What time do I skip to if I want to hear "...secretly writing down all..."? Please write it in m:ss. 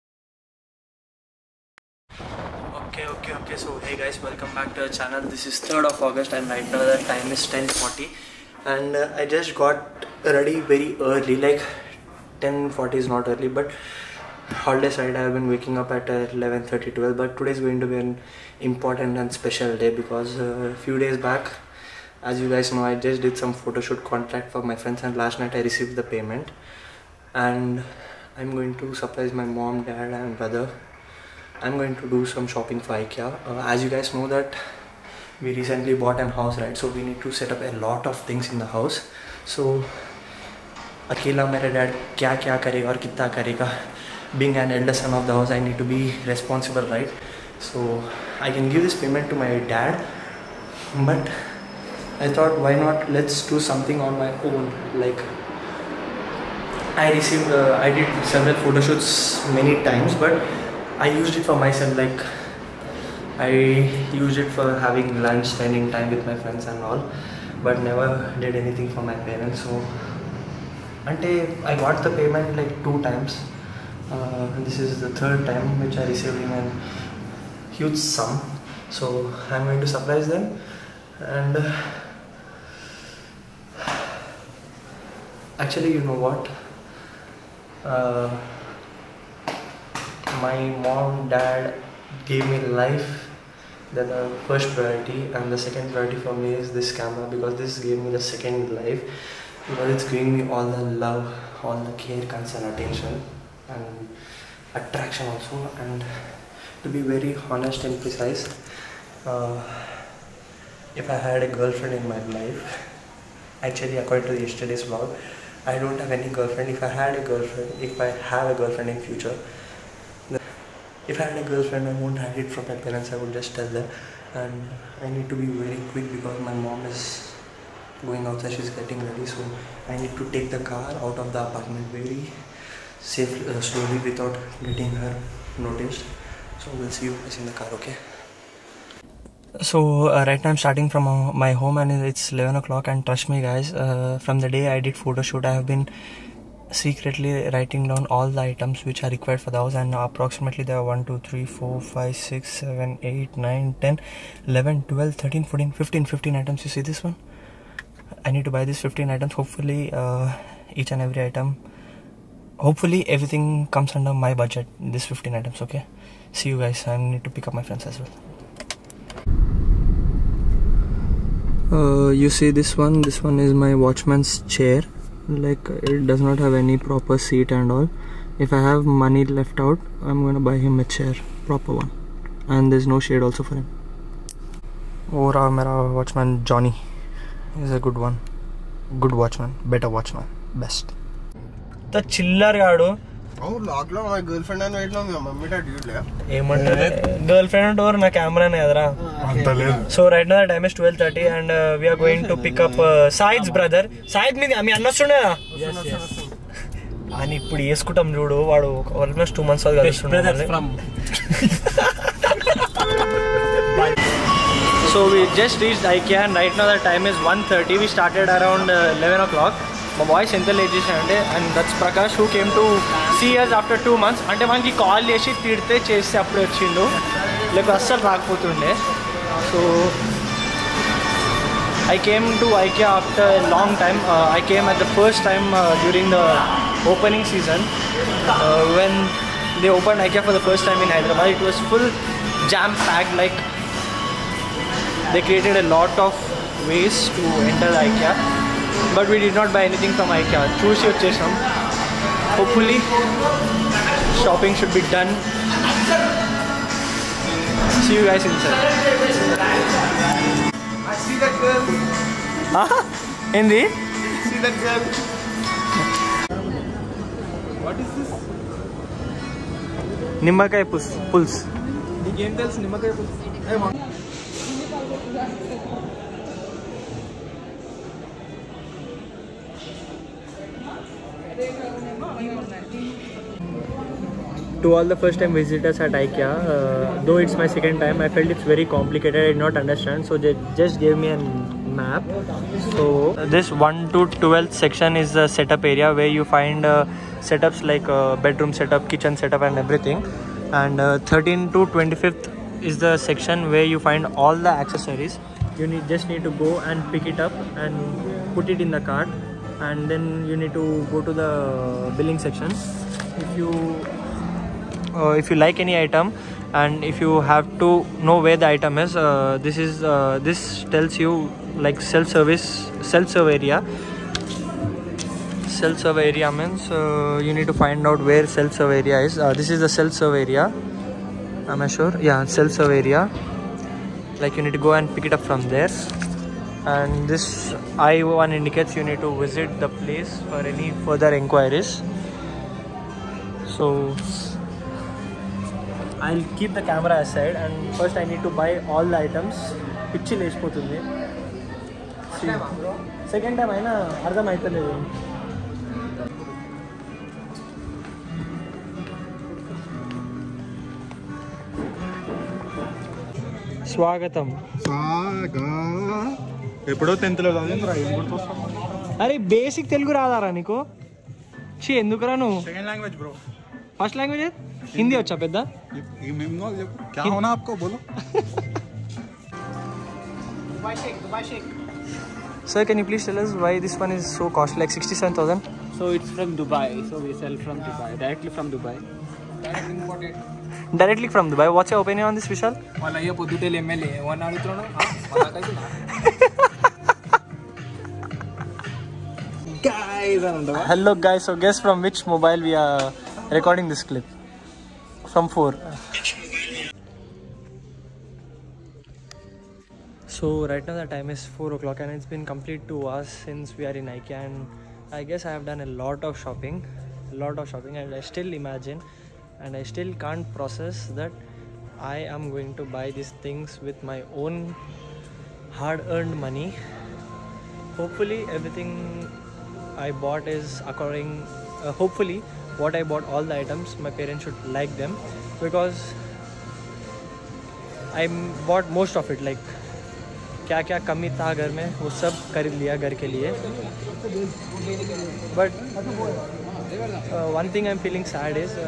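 2:26.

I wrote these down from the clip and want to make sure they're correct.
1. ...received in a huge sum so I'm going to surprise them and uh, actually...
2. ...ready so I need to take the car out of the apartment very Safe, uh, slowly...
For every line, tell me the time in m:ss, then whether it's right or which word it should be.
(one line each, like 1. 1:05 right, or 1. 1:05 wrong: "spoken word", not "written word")
1. 1:16 right
2. 2:09 right.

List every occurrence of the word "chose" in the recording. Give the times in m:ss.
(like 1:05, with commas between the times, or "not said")
not said.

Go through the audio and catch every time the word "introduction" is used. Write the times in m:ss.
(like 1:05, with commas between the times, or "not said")
not said.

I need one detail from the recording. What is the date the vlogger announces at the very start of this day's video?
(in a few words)
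3rd of August.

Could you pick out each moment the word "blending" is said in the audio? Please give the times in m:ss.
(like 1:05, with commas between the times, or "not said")
not said.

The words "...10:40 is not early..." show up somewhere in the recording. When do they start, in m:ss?
0:12.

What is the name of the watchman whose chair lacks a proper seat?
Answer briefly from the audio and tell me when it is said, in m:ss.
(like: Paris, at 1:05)
Johnny, at 3:06.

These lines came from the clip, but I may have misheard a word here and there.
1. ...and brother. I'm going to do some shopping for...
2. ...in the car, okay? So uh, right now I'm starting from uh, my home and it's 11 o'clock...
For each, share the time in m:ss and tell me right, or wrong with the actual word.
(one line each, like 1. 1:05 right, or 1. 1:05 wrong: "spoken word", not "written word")
1. 0:30 right
2. 2:17 right.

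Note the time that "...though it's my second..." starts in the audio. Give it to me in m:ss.
4:47.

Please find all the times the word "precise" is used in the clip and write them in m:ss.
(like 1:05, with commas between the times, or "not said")
1:48.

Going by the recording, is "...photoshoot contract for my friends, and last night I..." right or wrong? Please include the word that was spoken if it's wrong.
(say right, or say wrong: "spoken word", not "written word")
right.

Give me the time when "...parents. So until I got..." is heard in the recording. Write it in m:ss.
1:09.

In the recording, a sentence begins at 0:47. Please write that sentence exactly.
So I can give this payment to my dad, but I thought, why not?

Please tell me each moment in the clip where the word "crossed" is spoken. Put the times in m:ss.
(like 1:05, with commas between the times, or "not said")
not said.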